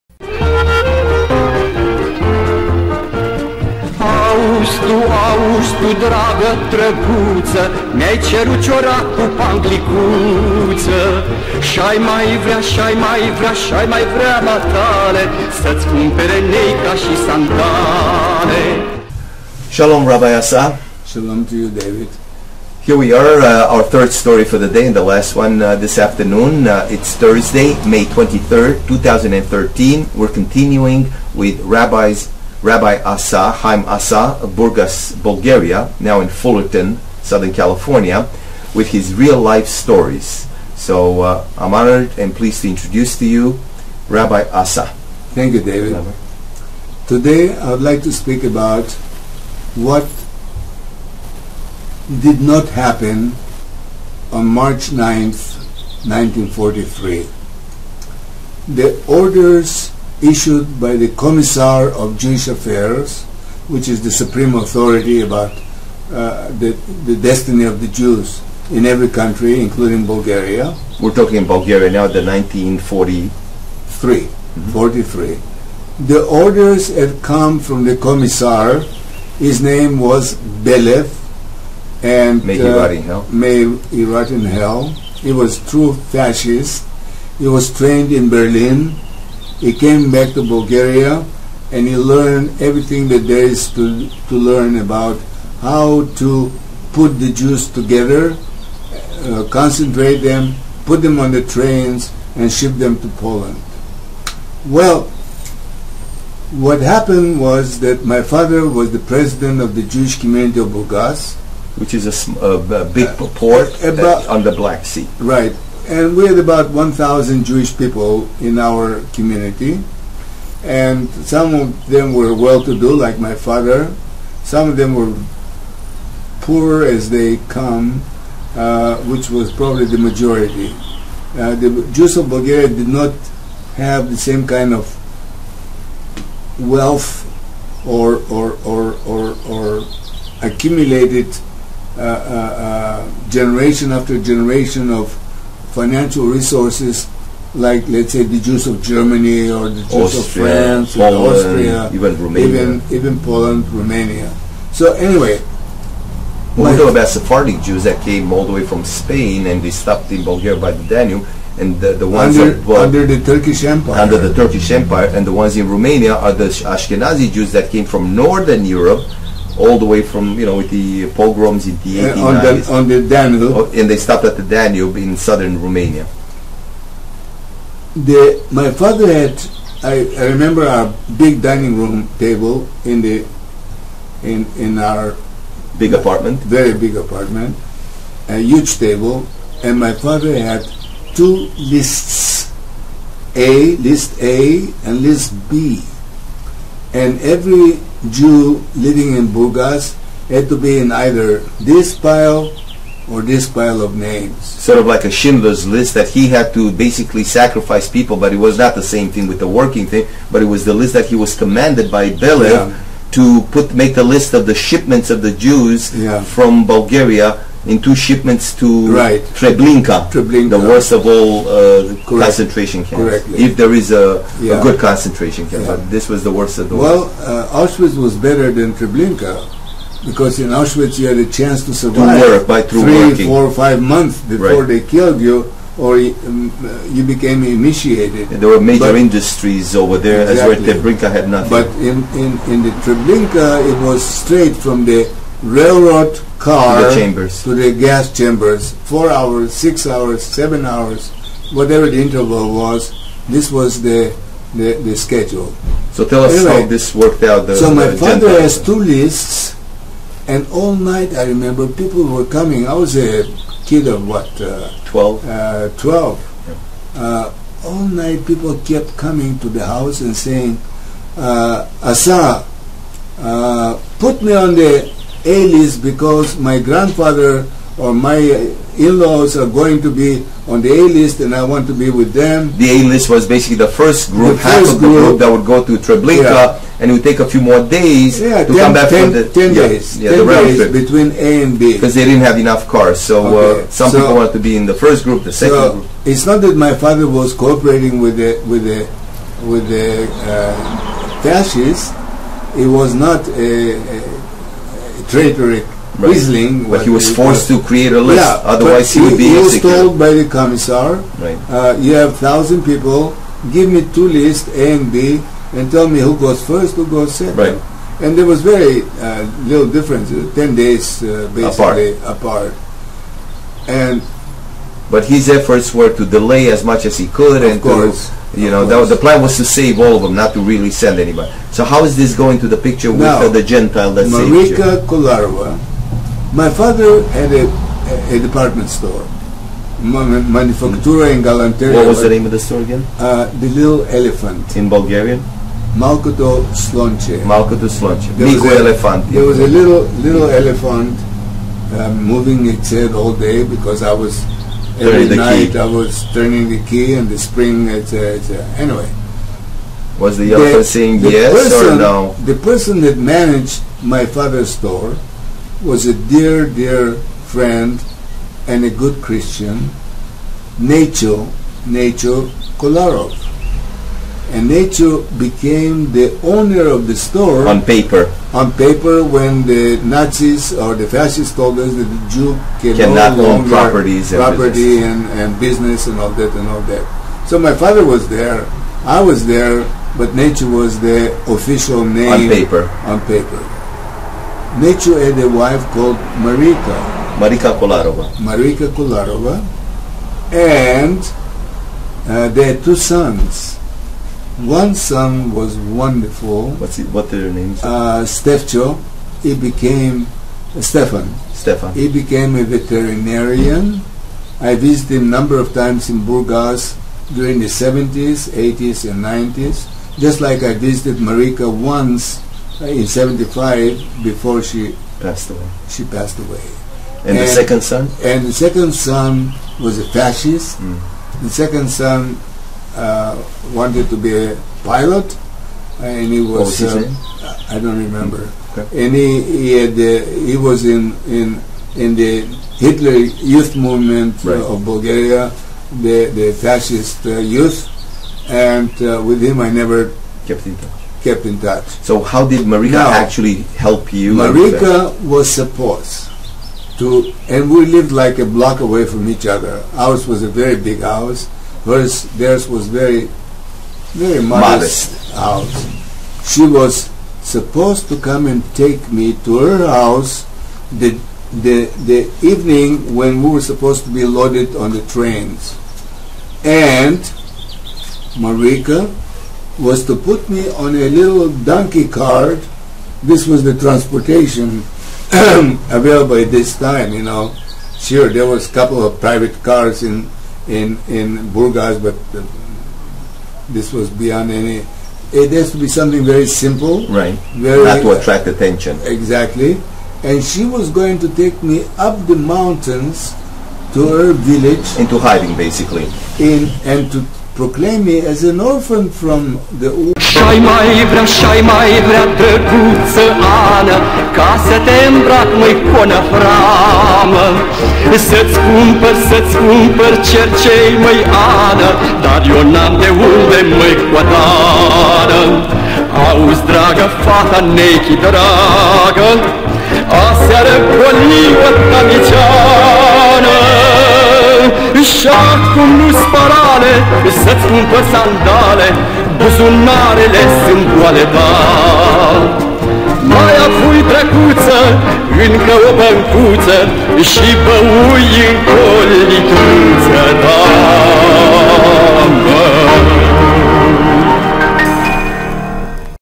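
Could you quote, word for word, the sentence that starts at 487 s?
Sure, there was a couple of private cars in in in Burgas, but uh, this was beyond any.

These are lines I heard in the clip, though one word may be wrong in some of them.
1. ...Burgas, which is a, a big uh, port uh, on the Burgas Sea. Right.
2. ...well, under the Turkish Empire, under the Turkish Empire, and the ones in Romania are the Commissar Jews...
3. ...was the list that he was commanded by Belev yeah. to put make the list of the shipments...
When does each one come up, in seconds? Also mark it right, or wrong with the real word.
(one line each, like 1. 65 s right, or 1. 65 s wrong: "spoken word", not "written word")
1. 110 s wrong: "Black", not "Burgas"
2. 162 s wrong: "Ashkenazi", not "Commissar"
3. 210 s right.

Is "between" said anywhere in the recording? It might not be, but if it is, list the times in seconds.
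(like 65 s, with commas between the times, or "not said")
290 s.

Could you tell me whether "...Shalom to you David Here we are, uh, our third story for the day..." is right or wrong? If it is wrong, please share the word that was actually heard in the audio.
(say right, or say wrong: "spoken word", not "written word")
right.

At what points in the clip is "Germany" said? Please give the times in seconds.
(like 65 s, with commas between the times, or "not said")
148 s.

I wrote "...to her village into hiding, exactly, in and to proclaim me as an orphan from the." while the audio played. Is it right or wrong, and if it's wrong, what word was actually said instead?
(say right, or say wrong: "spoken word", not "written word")
wrong: "basically", not "exactly".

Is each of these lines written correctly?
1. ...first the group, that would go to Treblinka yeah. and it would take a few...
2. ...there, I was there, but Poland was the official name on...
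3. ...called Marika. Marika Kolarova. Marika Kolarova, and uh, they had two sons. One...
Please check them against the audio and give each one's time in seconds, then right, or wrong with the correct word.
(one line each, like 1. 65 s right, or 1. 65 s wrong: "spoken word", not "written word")
1. 284 s right
2. 388 s wrong: "Nacho", not "Poland"
3. 395 s right.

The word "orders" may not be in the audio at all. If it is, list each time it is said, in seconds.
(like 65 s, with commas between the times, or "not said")
59 s, 76 s.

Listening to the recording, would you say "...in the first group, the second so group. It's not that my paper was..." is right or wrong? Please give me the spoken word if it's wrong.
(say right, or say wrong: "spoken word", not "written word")
wrong: "father", not "paper".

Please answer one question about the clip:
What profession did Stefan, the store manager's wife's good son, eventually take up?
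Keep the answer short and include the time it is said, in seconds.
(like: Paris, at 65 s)
Veterinarian, at 412 s.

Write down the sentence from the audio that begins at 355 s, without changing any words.
I was turning the key and the spring, it's, uh, anyway.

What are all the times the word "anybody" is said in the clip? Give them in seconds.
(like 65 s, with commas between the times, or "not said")
330 s.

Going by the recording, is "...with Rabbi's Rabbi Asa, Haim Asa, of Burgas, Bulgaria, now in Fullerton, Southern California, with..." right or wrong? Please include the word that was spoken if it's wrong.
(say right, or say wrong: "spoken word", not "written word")
right.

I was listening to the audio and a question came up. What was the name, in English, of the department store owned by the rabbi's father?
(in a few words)
The Little Elephant.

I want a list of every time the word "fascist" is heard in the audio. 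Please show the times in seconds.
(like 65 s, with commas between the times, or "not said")
86 s, 301 s, 380 s, 429 s, 446 s.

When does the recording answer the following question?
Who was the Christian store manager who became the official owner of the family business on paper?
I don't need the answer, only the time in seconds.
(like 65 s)
371 s.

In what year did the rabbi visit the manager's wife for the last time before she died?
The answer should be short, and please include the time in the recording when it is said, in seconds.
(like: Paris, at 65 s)
1975, at 422 s.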